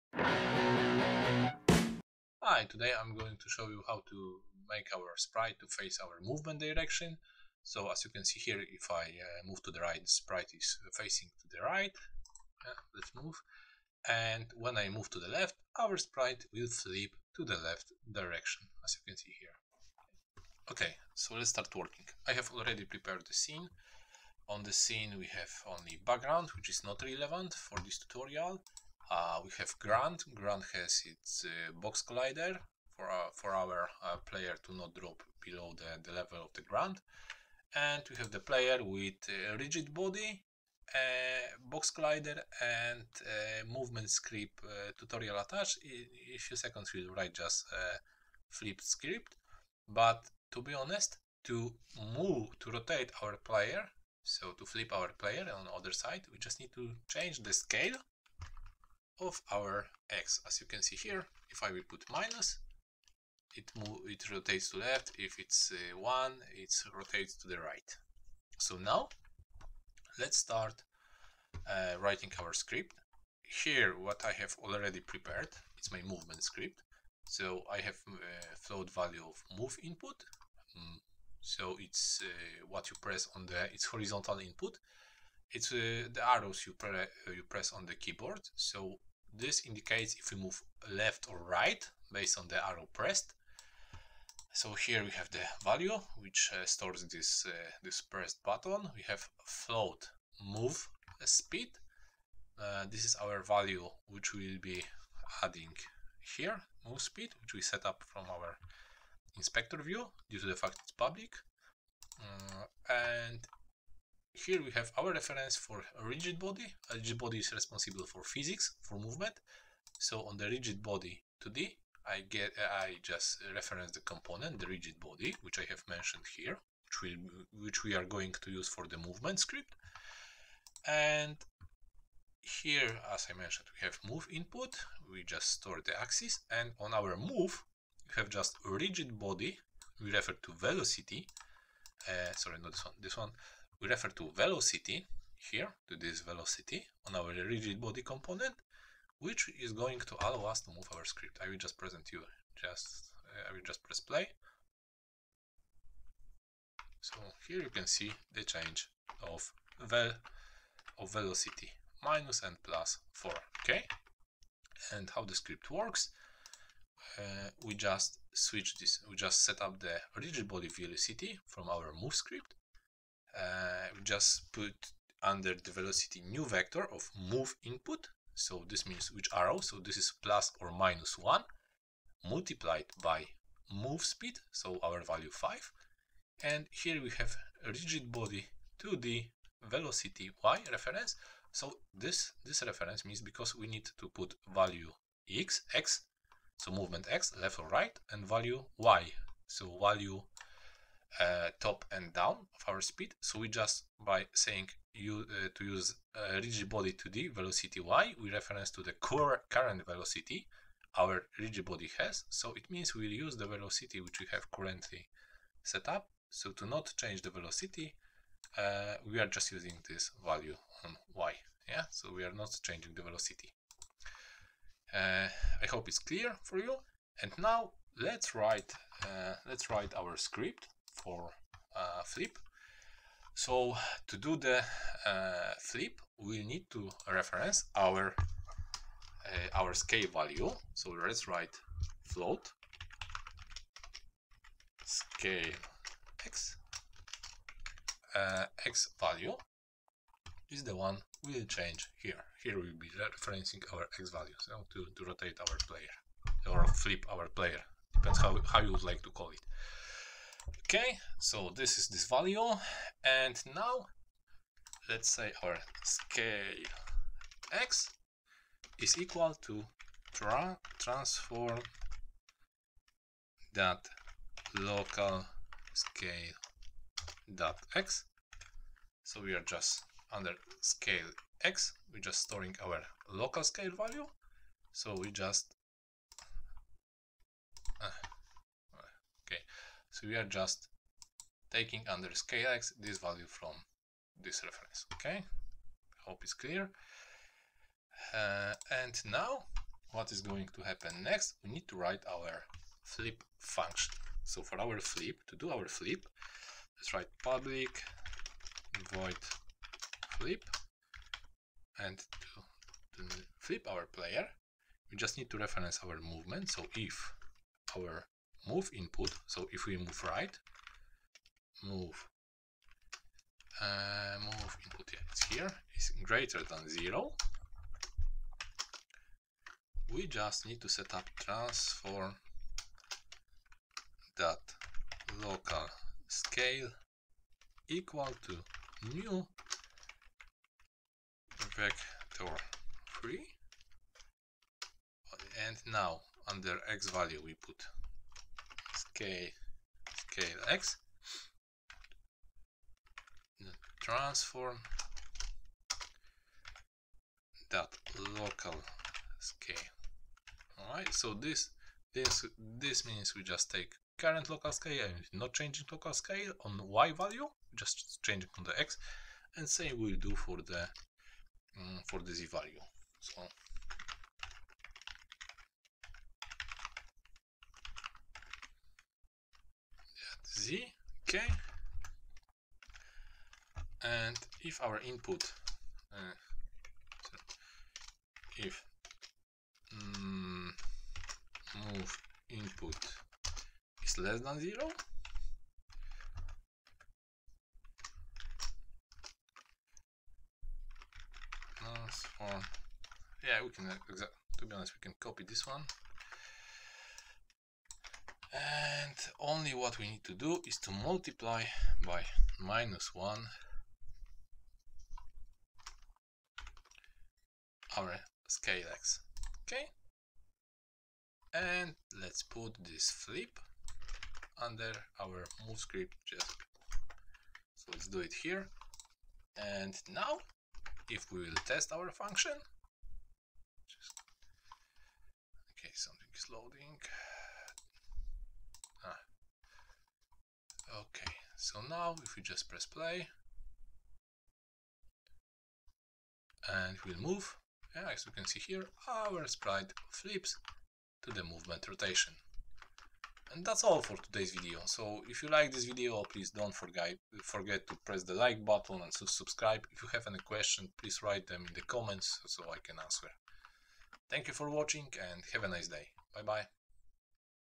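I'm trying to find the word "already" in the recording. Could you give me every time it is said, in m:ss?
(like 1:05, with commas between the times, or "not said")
0:22, 1:14.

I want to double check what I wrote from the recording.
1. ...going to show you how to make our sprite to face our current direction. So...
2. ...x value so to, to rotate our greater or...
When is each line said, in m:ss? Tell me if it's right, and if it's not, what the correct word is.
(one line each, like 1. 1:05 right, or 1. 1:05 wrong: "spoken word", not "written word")
1. 0:03 wrong: "movement", not "current"
2. 4:13 wrong: "player", not "greater".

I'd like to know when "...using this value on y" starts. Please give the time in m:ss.
3:39.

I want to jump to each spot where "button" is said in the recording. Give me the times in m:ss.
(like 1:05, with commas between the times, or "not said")
1:38, 7:38.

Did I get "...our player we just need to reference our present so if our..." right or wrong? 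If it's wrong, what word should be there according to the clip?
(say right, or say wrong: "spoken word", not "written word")
wrong: "movement", not "present".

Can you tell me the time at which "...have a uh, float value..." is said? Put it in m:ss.
1:17.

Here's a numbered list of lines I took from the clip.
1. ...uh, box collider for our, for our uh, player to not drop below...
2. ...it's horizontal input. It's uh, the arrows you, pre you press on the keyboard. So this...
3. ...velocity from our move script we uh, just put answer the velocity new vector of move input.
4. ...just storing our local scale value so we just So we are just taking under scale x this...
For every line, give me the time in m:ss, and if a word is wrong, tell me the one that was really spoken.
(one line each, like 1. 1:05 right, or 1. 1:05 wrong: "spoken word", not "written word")
1. 0:31 right
2. 1:23 right
3. 2:50 wrong: "under", not "answer"
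4. 4:42 right.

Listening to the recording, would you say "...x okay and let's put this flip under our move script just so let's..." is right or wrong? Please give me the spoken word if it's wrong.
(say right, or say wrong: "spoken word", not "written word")
right.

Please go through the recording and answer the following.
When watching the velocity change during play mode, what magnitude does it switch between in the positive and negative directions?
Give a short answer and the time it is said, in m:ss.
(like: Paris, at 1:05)
4, at 2:42.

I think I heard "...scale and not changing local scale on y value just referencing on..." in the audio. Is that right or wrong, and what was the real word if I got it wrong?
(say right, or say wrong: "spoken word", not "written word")
wrong: "changing", not "referencing".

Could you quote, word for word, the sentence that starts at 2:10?
And here, as I mentioned, we have move input.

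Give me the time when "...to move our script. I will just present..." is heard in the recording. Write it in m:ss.
2:30.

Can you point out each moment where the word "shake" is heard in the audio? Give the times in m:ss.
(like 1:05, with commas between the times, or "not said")
not said.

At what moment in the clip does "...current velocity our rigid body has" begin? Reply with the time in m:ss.
3:29.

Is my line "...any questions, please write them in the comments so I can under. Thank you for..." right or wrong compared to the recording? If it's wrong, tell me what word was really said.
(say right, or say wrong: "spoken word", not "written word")
wrong: "answer", not "under".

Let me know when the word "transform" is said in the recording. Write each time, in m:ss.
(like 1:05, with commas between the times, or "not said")
4:30, 5:31, 5:53, 6:41.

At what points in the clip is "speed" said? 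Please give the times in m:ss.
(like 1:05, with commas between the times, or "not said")
1:41, 1:47, 3:04, 3:22.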